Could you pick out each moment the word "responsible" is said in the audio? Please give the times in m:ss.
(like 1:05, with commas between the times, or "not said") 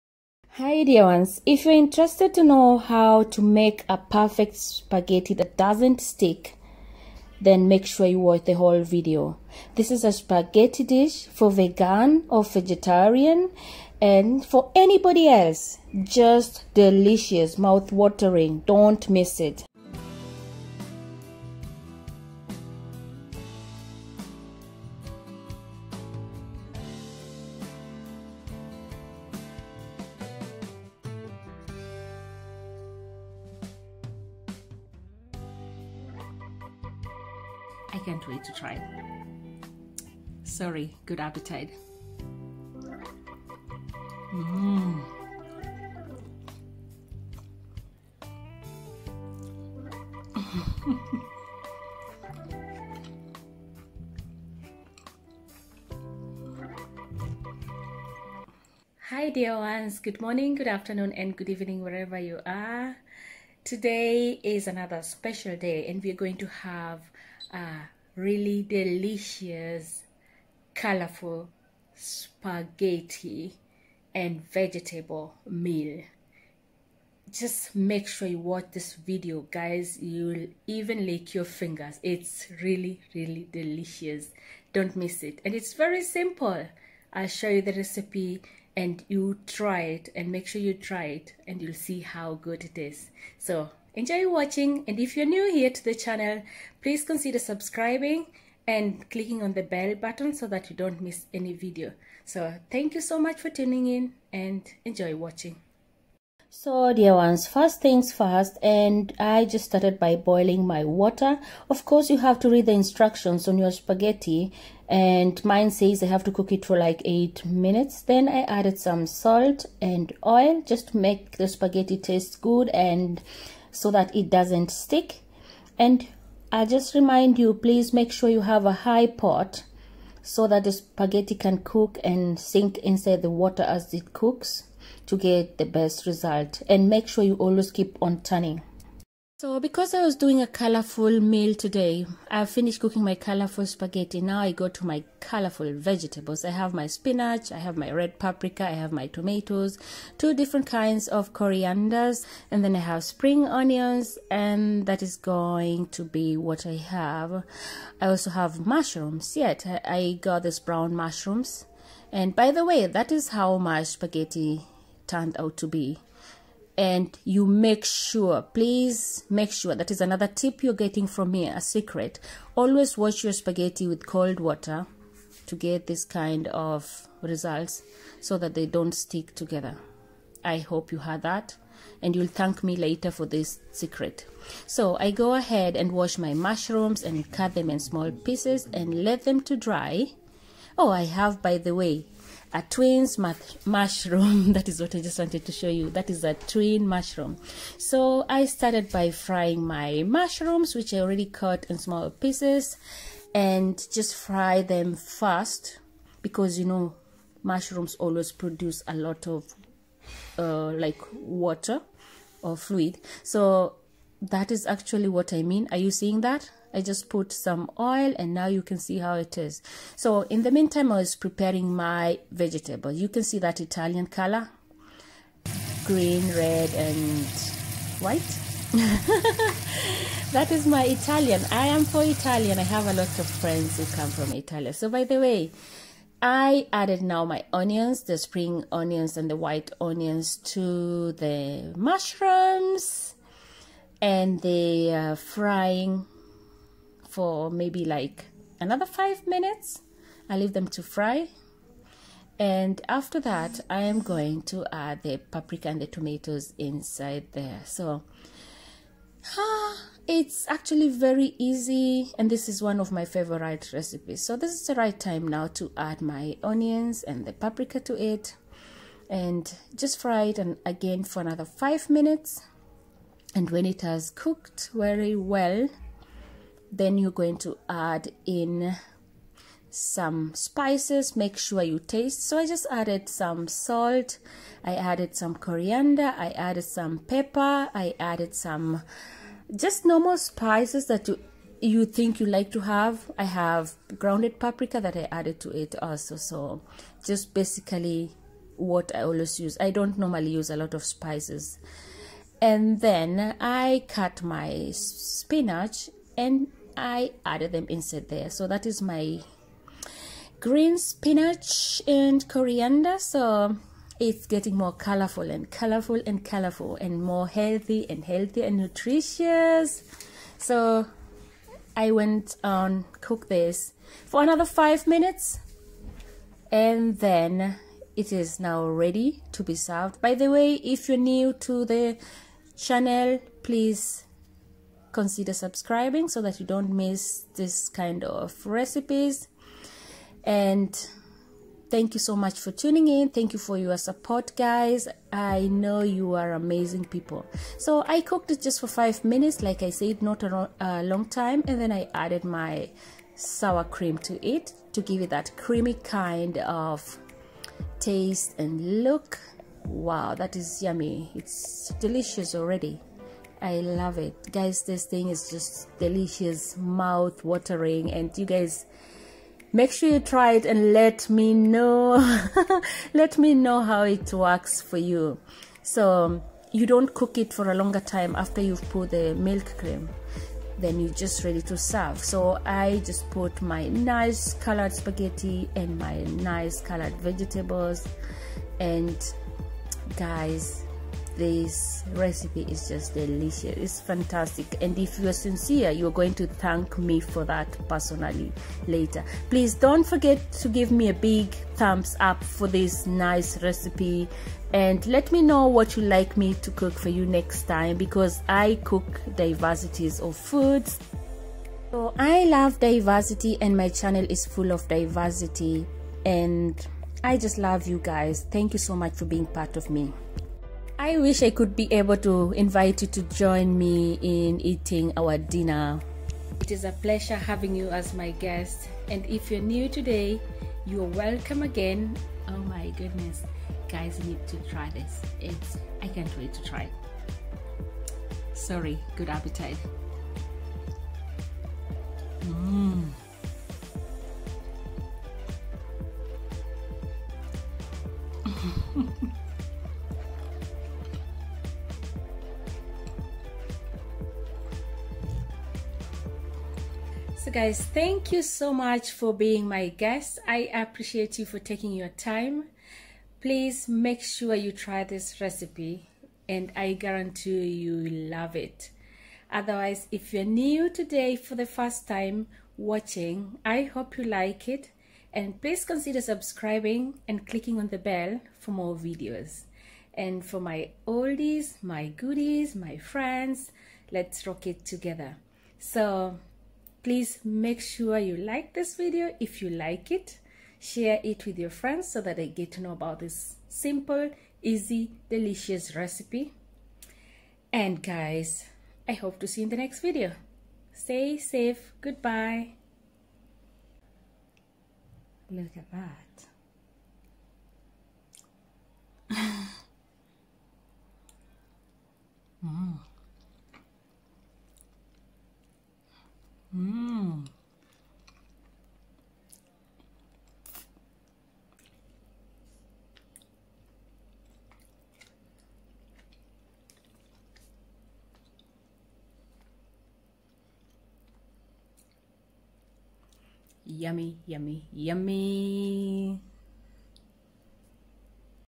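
not said.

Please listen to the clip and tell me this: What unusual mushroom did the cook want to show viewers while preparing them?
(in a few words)
A twin mushroom.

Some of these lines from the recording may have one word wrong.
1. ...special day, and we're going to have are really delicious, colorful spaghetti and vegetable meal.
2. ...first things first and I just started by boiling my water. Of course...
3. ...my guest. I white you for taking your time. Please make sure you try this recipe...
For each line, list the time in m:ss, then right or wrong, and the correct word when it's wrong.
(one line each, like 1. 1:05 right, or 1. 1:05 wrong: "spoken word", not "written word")
1. 1:05 right
2. 1:47 right
3. 7:39 wrong: "appreciate", not "white".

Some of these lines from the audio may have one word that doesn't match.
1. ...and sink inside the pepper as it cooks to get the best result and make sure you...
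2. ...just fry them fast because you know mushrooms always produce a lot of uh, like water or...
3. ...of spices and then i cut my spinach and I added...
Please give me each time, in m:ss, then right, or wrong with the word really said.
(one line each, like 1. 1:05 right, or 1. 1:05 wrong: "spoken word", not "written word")
1. 2:12 wrong: "water", not "pepper"
2. 3:23 right
3. 5:00 right.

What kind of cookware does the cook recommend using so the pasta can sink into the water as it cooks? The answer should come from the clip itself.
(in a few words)
A high pot.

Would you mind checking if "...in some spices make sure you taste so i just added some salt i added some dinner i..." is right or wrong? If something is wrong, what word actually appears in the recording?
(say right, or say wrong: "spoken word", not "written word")
wrong: "coriander", not "dinner".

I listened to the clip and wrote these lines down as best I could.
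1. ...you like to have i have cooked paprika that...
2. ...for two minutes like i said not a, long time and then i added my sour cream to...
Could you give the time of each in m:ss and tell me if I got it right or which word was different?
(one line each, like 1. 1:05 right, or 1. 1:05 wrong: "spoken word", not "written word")
1. 4:52 wrong: "grounded", not "cooked"
2. 5:48 wrong: "five", not "two".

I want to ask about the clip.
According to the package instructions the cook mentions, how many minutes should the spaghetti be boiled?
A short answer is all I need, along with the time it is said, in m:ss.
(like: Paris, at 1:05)
8 minutes, at 1:57.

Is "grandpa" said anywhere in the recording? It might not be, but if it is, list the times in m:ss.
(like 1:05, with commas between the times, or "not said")
not said.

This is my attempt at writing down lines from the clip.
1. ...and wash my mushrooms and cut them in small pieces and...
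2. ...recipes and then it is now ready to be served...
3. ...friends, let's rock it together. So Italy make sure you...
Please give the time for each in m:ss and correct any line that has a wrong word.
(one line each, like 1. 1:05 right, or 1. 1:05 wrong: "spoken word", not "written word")
1. 3:05 right
2. 5:24 wrong: "minutes", not "recipes"
3. 8:02 wrong: "Please", not "Italy".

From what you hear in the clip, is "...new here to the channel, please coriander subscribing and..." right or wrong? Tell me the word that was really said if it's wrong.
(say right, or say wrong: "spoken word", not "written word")
wrong: "consider", not "coriander".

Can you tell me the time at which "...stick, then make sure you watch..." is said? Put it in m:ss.
0:06.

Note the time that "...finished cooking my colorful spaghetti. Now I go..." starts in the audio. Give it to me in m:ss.
2:22.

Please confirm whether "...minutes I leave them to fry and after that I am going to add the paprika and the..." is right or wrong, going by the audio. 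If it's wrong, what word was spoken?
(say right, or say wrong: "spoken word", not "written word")
right.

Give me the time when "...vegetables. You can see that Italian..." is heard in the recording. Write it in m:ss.
3:42.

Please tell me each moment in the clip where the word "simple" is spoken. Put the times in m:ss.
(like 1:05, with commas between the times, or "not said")
1:26, 8:13.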